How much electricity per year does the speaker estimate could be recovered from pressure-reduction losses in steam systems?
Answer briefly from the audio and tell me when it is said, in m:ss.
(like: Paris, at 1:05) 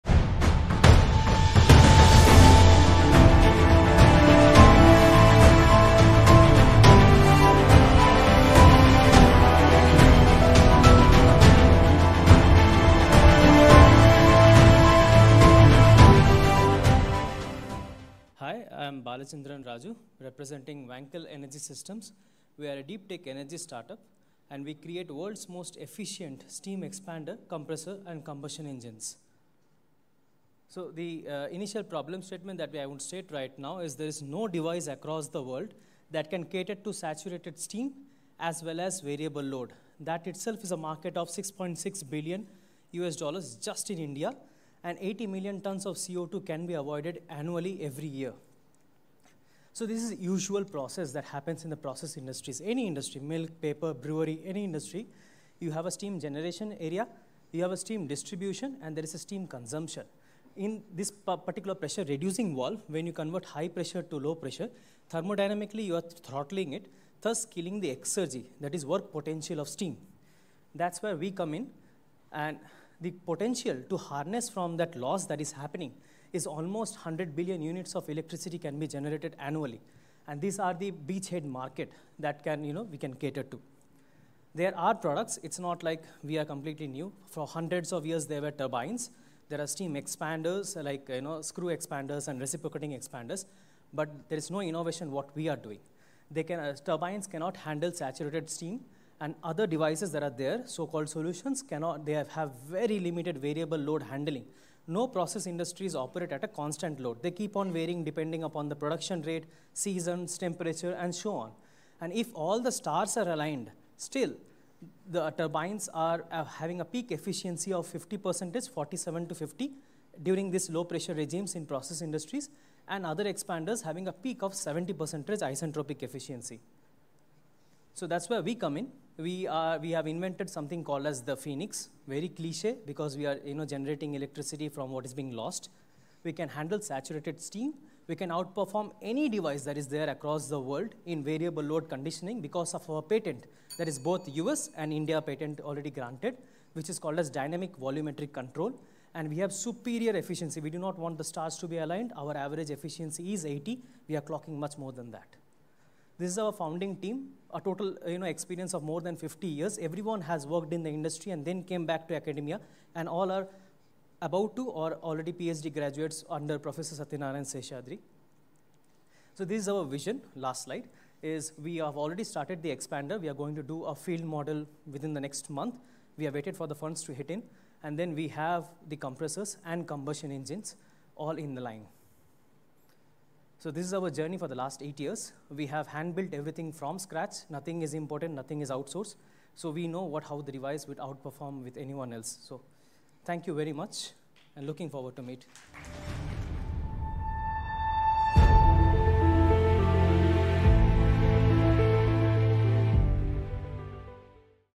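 100 billion units, at 1:16.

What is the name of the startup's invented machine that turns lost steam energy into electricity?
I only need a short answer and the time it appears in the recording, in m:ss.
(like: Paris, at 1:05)
Phoenix, at 2:11.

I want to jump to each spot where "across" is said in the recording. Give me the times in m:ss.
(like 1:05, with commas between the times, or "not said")
0:34, 2:20.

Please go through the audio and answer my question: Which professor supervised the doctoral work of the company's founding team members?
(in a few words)
Satyanarayan Seshadri.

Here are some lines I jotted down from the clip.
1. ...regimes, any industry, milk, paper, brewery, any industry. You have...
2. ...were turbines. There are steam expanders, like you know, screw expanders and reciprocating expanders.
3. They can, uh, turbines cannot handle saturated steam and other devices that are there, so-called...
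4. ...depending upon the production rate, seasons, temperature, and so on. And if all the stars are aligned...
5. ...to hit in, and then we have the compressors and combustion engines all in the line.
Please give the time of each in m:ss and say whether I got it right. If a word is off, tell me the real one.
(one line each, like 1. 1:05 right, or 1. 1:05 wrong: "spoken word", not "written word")
1. 0:52 wrong: "industries", not "regimes"
2. 1:28 right
3. 1:36 right
4. 1:48 right
5. 2:57 right.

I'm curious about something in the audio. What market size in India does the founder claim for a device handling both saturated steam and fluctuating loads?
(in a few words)
6.6 billion US dollars.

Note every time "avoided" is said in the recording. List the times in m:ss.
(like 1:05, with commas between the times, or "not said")
0:46.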